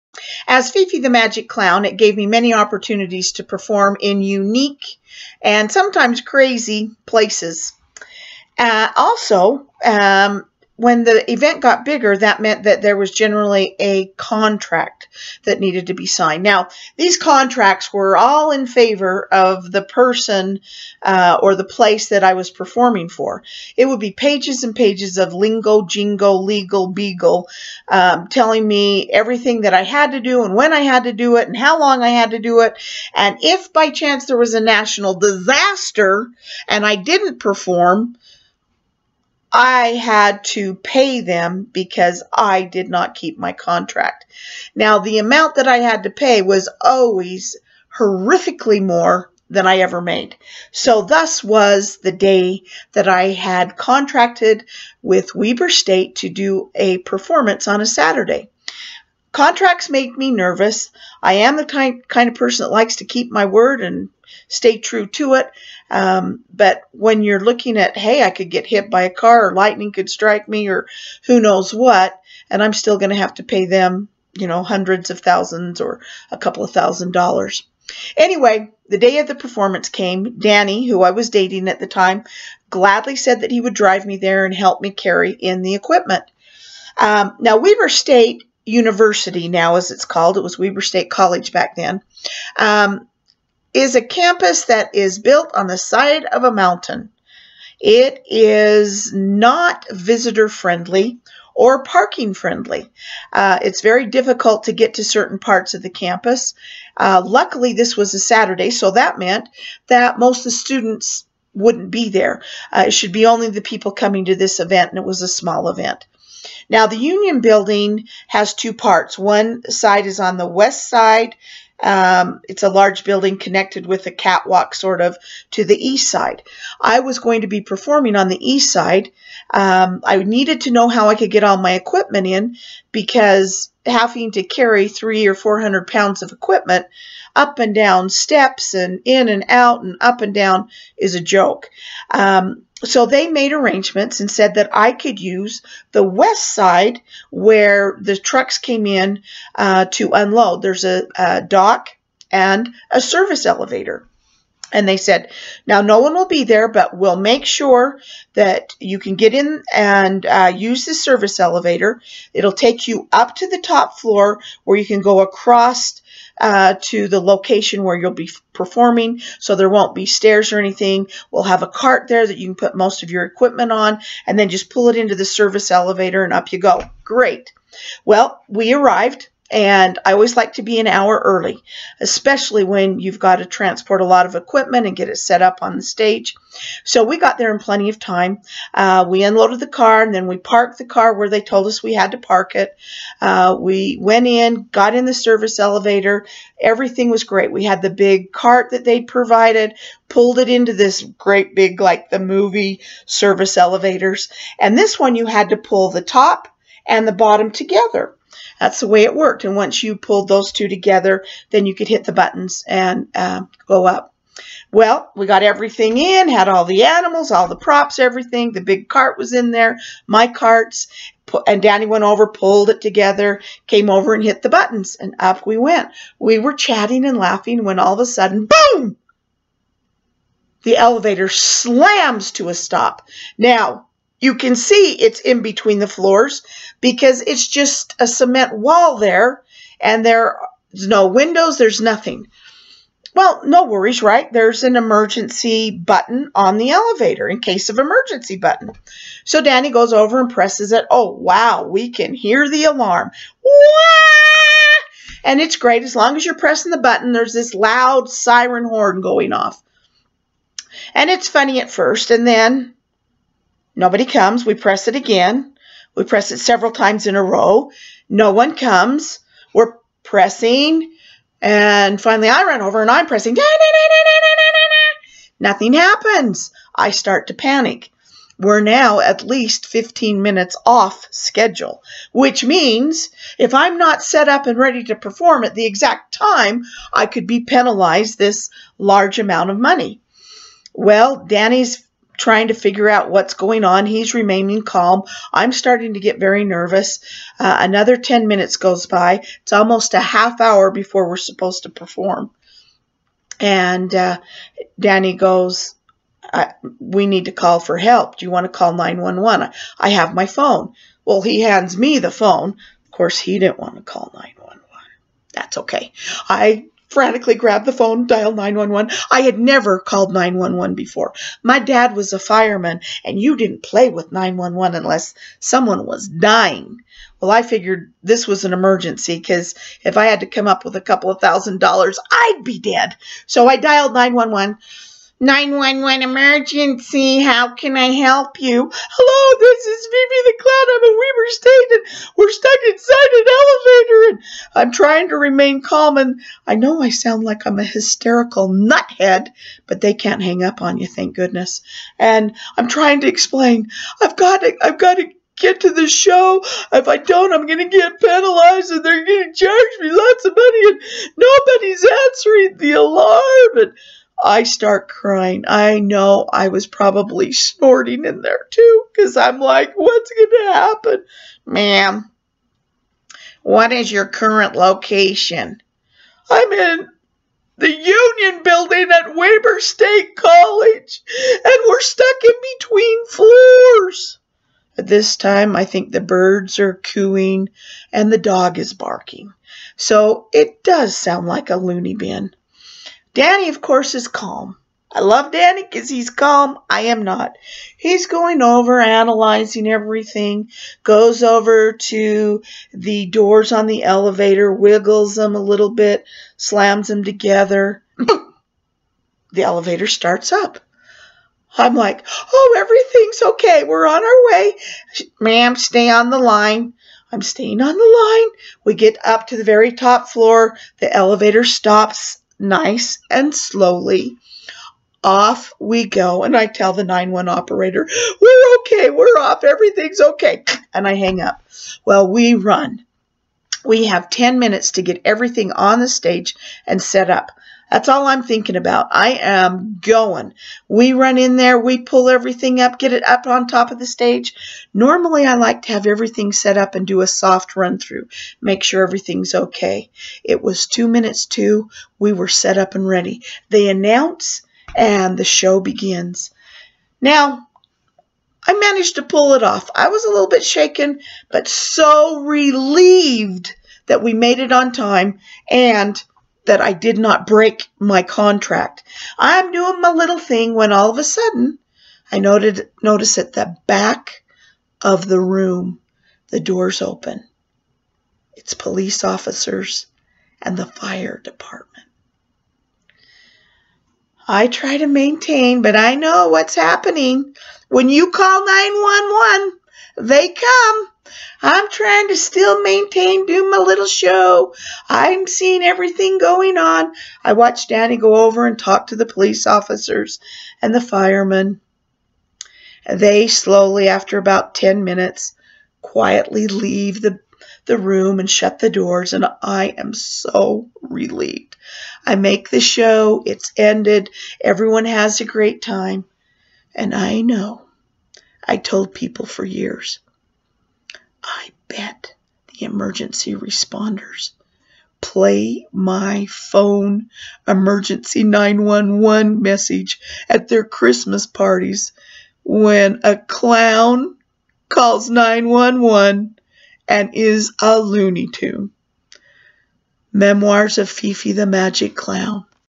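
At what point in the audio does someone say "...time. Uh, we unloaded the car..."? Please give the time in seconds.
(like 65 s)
187 s.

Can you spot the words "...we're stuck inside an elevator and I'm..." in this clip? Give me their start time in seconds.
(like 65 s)
342 s.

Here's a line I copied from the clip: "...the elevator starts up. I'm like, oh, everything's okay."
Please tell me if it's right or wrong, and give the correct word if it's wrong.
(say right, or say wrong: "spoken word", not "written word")
right.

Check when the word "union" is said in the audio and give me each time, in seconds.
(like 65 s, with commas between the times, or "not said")
116 s, 377 s.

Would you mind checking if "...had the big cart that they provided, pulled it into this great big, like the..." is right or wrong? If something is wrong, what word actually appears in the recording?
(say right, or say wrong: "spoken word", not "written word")
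right.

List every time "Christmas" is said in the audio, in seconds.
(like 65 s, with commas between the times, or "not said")
530 s.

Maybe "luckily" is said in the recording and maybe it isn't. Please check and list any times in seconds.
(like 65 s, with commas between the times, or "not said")
107 s.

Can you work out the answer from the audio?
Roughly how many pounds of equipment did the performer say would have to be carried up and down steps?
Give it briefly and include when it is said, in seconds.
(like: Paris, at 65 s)
300 or 400, at 134 s.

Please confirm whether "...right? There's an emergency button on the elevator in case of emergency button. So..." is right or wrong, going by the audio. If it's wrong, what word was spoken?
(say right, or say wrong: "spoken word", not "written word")
right.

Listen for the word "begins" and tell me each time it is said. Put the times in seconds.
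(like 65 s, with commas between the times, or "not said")
455 s.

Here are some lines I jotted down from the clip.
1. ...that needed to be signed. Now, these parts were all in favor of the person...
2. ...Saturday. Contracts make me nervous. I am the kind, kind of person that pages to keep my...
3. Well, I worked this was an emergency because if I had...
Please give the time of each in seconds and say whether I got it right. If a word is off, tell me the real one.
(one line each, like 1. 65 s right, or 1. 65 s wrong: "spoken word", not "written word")
1. 15 s wrong: "contracts", not "parts"
2. 57 s wrong: "likes", not "pages"
3. 327 s wrong: "figured", not "worked".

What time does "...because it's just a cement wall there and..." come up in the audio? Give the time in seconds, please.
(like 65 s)
236 s.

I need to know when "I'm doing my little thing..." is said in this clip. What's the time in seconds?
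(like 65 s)
469 s.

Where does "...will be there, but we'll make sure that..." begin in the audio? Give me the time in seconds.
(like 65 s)
156 s.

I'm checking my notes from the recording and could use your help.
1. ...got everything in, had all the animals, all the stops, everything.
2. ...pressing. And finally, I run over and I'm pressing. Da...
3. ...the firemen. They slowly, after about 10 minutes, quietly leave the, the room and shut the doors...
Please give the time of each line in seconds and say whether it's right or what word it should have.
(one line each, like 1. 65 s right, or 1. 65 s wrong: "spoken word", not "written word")
1. 215 s wrong: "props", not "stops"
2. 270 s right
3. 500 s right.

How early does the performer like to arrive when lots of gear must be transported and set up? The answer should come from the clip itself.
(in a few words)
an hour.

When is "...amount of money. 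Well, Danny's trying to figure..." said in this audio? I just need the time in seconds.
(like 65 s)
289 s.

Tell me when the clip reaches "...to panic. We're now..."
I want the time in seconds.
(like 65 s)
277 s.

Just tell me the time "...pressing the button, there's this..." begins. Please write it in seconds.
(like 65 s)
256 s.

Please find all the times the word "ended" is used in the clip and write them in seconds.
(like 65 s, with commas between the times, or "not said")
513 s.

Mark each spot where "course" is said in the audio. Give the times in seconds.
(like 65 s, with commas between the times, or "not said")
312 s, 393 s.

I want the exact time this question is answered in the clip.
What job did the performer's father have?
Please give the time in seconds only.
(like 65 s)
322 s.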